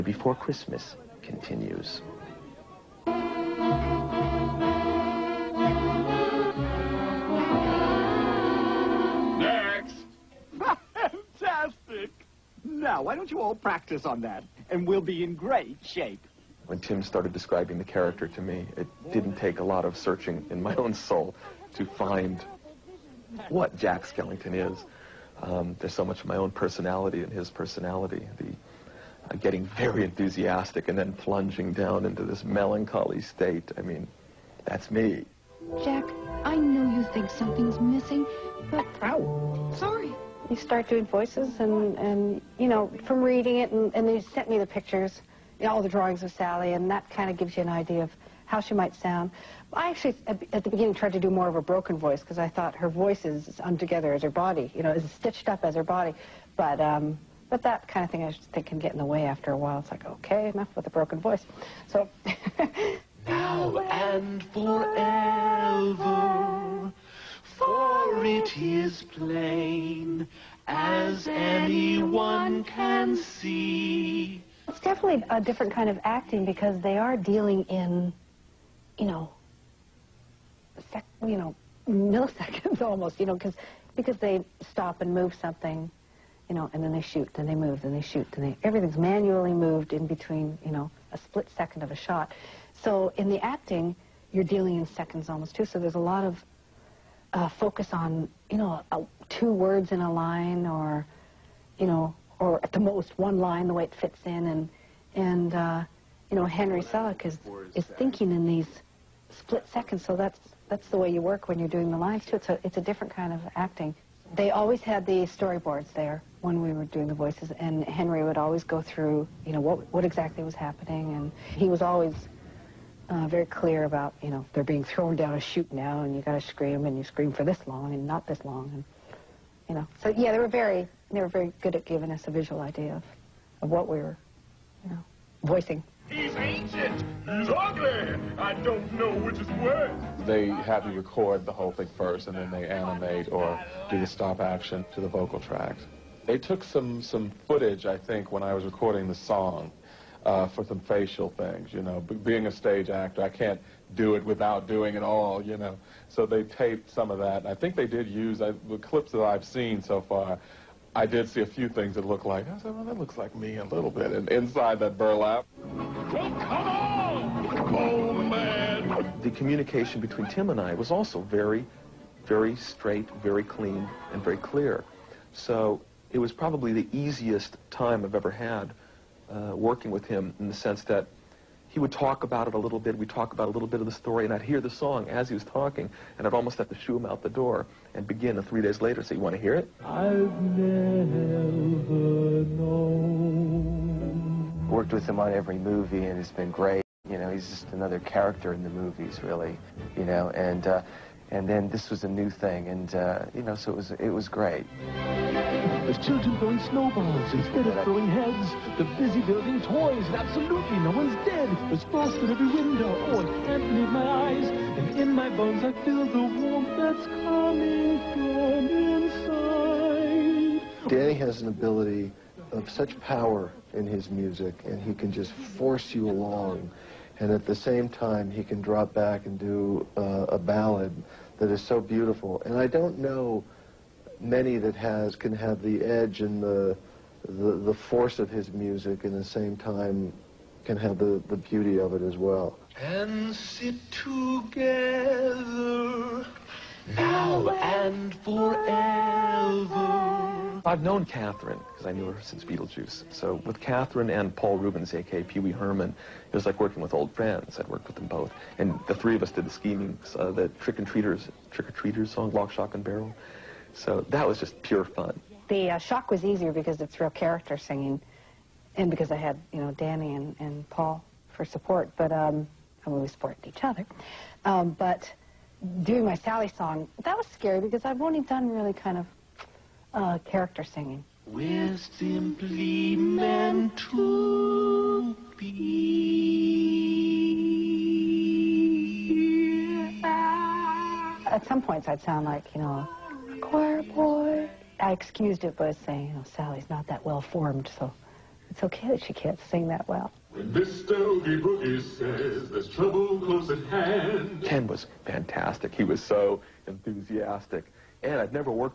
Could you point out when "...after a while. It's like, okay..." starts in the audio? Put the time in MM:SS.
00:59.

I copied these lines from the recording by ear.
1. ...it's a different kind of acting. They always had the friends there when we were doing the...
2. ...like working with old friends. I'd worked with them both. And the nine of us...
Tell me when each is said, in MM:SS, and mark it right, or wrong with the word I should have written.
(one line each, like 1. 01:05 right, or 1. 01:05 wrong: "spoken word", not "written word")
1. 01:52 wrong: "storyboards", not "friends"
2. 04:16 wrong: "three", not "nine".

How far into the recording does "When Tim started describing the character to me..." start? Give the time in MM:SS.
00:16.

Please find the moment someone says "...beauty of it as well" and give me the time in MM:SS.
04:01.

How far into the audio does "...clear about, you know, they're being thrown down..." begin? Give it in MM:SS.
02:03.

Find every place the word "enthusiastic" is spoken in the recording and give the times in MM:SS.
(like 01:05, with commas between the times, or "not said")
00:30, 05:06.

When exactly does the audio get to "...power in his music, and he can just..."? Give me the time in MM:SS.
03:43.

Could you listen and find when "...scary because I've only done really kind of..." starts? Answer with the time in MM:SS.
04:37.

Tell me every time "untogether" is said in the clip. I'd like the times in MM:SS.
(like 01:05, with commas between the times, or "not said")
00:53.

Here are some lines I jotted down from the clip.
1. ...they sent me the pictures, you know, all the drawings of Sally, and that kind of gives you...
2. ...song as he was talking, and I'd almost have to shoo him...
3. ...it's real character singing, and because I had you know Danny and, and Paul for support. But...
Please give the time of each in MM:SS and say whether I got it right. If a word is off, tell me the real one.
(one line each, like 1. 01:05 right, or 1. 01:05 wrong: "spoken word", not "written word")
1. 00:44 right
2. 03:04 right
3. 04:26 right.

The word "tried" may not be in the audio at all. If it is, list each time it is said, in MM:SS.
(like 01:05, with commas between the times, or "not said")
00:50.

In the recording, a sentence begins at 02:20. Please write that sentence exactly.
They have you record the whole thing first, and then they animate or do the stop action to the vocal tracks.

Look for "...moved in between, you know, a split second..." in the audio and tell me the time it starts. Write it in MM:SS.
01:29.